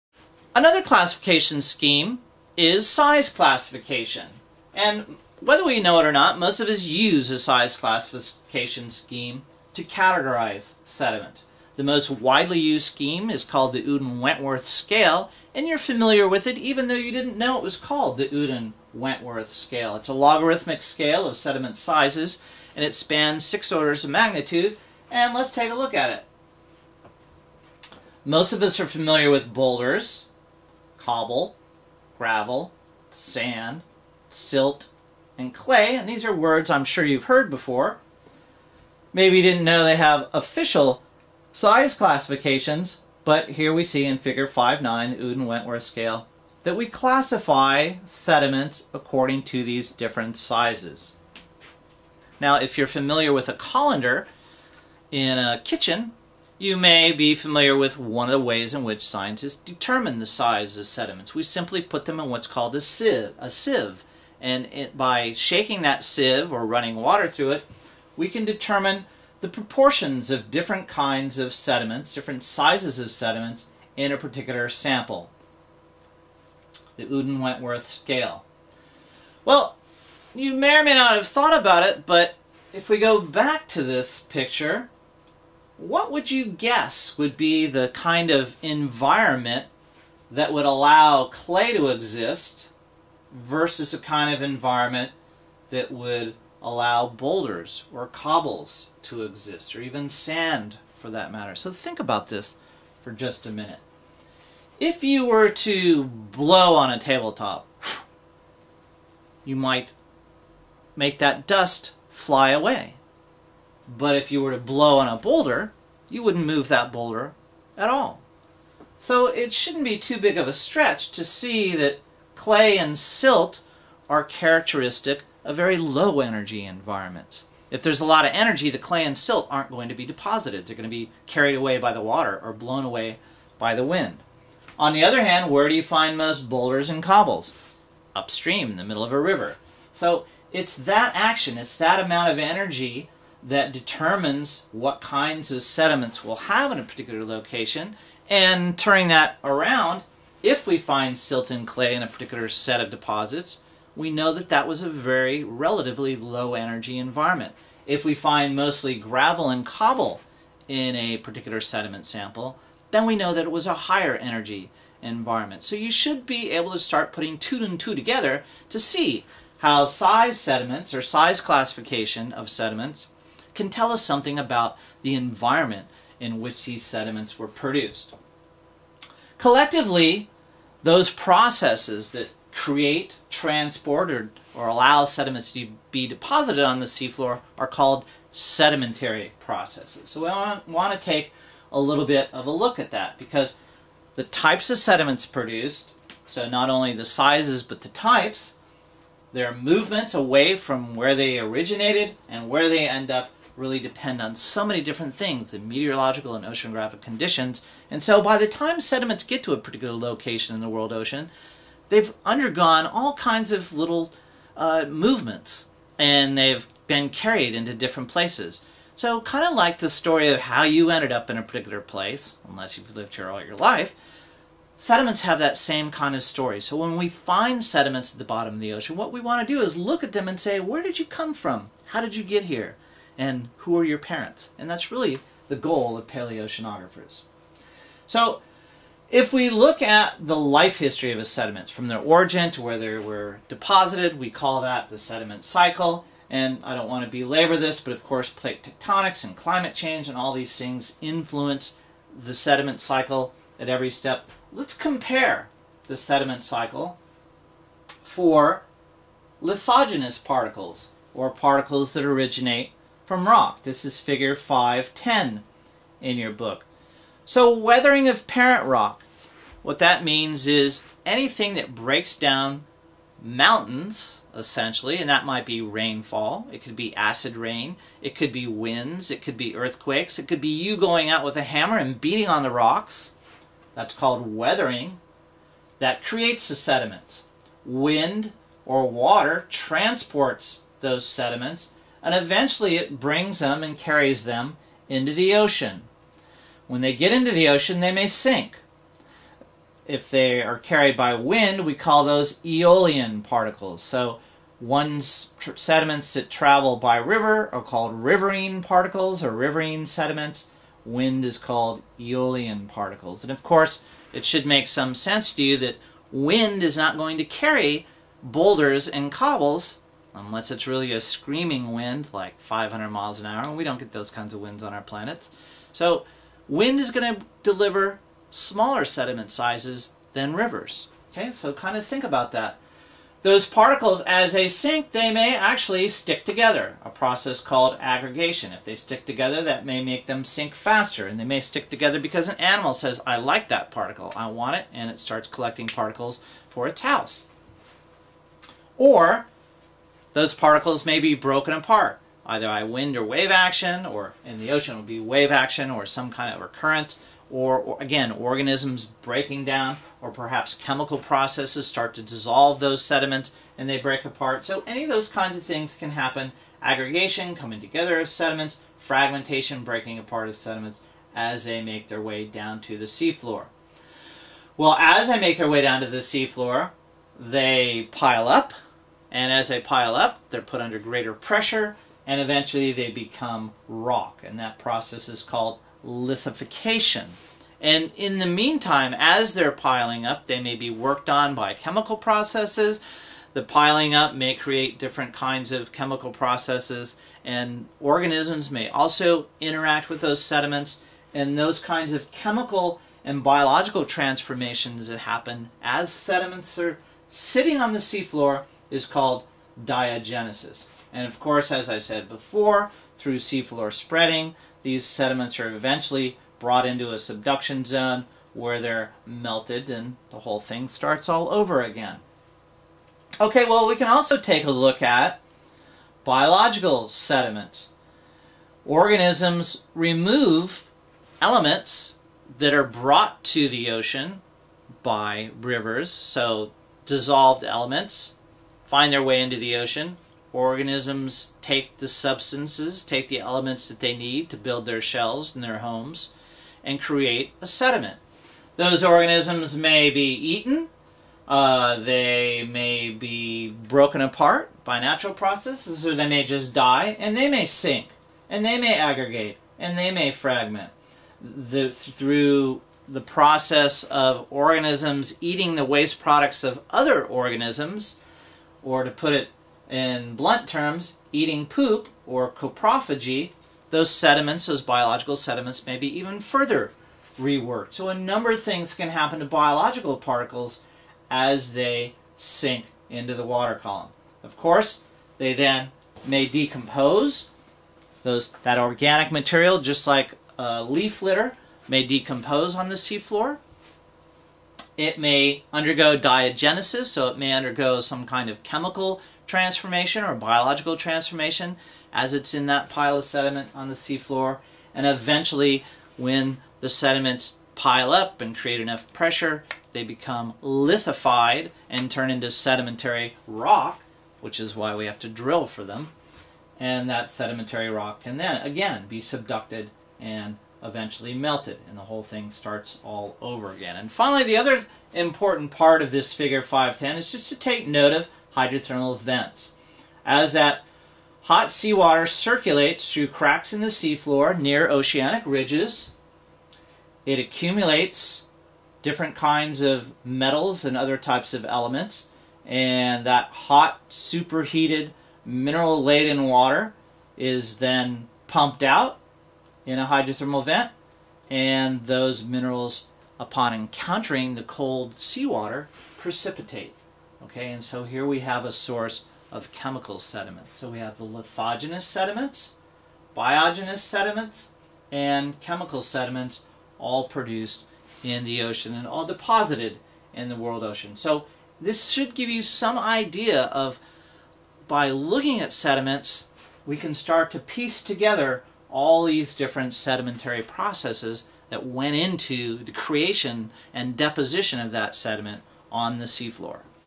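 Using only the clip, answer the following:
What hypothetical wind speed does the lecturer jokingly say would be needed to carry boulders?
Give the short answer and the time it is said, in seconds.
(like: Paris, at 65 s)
500 miles an hour, at 322 s.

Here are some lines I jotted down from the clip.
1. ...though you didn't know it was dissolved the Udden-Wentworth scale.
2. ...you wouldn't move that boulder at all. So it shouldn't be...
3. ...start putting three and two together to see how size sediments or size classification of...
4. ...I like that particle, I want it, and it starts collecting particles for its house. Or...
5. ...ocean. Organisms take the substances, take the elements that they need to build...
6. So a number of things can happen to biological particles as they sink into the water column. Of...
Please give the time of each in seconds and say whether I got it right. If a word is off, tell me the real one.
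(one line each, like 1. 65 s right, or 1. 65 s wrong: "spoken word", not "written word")
1. 16 s wrong: "called", not "dissolved"
2. 116 s right
3. 166 s wrong: "two", not "three"
4. 343 s right
5. 439 s right
6. 477 s right.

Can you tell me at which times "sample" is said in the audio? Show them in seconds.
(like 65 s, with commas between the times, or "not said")
74 s, 162 s.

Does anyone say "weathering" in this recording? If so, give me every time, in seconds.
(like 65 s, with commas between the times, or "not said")
267 s, 284 s.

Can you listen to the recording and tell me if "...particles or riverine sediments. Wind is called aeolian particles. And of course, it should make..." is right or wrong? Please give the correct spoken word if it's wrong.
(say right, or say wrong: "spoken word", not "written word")
right.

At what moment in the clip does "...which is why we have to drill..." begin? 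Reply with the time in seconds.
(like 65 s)
514 s.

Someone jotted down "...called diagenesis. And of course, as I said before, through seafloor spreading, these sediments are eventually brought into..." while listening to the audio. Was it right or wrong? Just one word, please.
right.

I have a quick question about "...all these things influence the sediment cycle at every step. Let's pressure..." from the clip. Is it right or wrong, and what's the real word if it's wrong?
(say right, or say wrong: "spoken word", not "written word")
wrong: "compare", not "pressure".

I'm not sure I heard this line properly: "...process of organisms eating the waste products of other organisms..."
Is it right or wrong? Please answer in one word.
right.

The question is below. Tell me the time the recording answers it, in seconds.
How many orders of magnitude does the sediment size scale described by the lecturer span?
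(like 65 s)
23 s.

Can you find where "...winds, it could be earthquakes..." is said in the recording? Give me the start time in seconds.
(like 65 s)
278 s.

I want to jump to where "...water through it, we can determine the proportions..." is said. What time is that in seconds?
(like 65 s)
66 s.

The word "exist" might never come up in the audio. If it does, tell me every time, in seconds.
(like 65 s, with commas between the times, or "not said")
91 s, 99 s.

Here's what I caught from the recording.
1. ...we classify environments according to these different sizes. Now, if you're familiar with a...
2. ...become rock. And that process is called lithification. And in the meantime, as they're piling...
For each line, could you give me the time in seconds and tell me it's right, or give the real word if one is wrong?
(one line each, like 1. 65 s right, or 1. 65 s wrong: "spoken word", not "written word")
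1. 46 s wrong: "sediments", not "environments"
2. 382 s right.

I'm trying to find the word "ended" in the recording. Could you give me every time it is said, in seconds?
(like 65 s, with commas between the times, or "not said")
220 s.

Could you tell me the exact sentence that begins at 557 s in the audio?
Okay, and so here we have a source of chemical sediments.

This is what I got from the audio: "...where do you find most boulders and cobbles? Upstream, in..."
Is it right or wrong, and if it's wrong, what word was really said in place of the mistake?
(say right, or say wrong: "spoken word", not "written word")
right.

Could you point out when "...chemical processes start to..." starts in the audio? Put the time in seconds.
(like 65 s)
360 s.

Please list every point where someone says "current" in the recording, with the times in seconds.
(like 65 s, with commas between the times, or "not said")
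356 s.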